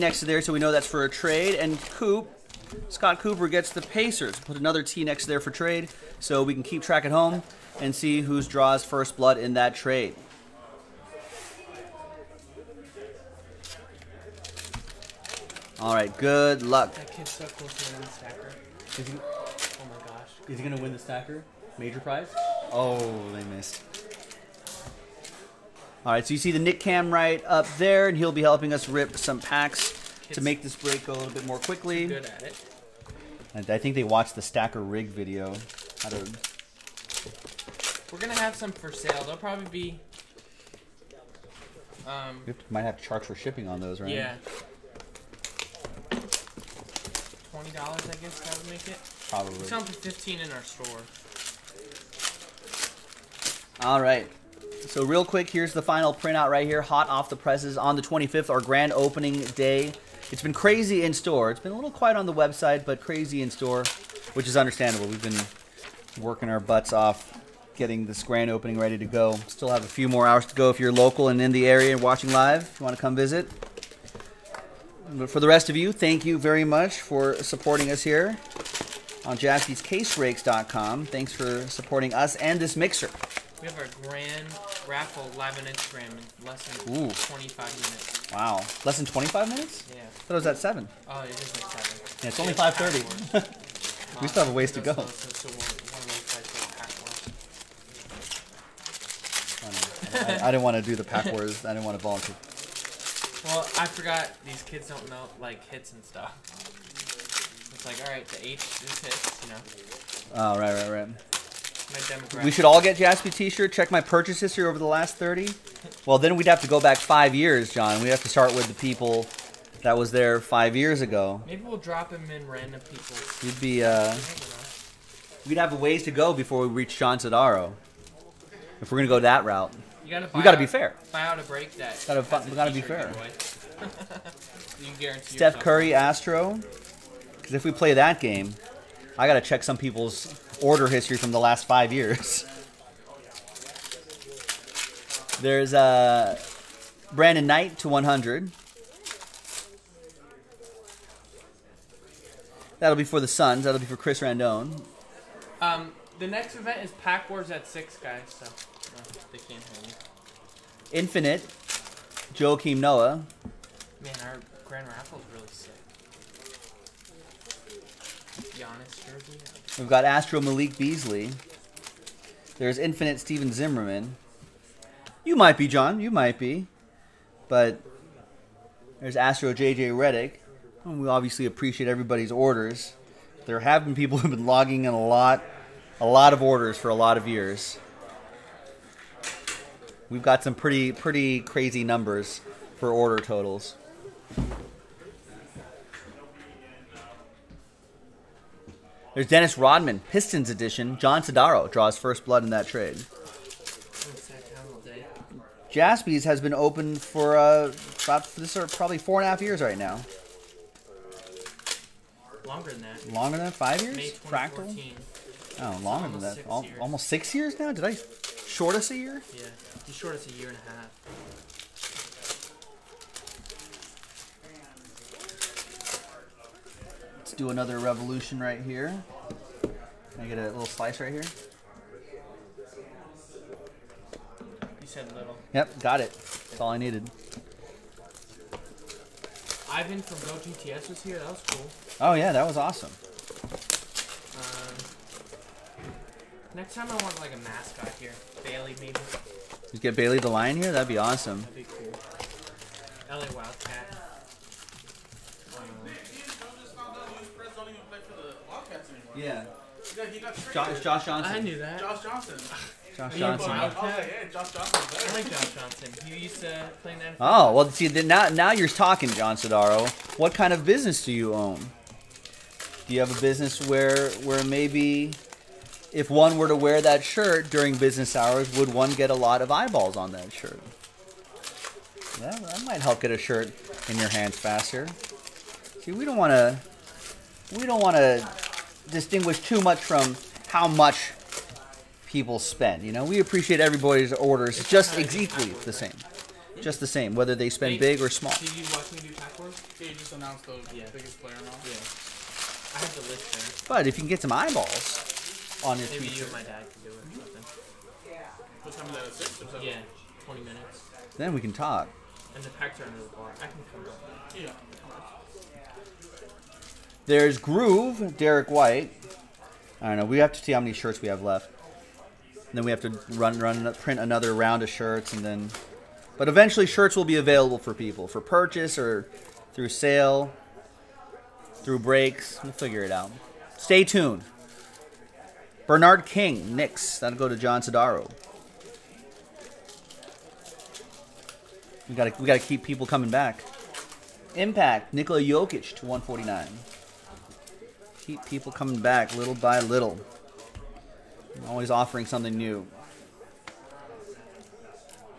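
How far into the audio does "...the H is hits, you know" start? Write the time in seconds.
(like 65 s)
108 s.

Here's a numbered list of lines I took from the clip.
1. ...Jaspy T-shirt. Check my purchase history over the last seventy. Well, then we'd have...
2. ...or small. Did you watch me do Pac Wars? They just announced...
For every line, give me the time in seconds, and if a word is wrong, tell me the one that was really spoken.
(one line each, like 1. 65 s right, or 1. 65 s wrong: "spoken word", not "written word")
1. 112 s wrong: "thirty", not "seventy"
2. 298 s right.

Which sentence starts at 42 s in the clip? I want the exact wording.
Um, we might have to charge for shipping on those, right?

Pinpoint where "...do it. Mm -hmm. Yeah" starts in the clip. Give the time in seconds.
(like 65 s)
306 s.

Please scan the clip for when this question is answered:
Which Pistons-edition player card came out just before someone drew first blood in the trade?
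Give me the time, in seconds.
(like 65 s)
199 s.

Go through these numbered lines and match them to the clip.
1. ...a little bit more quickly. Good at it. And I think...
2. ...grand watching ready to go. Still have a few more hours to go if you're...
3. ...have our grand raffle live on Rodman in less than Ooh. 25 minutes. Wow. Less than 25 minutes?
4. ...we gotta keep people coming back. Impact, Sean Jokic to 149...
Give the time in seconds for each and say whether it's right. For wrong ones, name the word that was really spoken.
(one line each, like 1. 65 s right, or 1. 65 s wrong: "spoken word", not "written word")
1. 31 s right
2. 68 s wrong: "opening", not "watching"
3. 83 s wrong: "Instagram", not "Rodman"
4. 342 s wrong: "Nikola", not "Sean".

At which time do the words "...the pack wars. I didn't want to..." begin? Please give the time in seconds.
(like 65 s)
100 s.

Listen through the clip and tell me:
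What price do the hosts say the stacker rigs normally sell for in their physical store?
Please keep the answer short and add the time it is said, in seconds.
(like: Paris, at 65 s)
$15, at 49 s.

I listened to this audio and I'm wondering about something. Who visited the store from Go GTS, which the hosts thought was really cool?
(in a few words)
Ivan.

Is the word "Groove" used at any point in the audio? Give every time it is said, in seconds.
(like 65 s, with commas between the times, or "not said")
317 s.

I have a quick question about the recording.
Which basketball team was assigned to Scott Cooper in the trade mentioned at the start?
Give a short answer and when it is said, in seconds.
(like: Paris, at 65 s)
Pacers, at 3 s.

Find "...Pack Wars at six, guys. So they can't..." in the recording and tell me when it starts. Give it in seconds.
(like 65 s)
157 s.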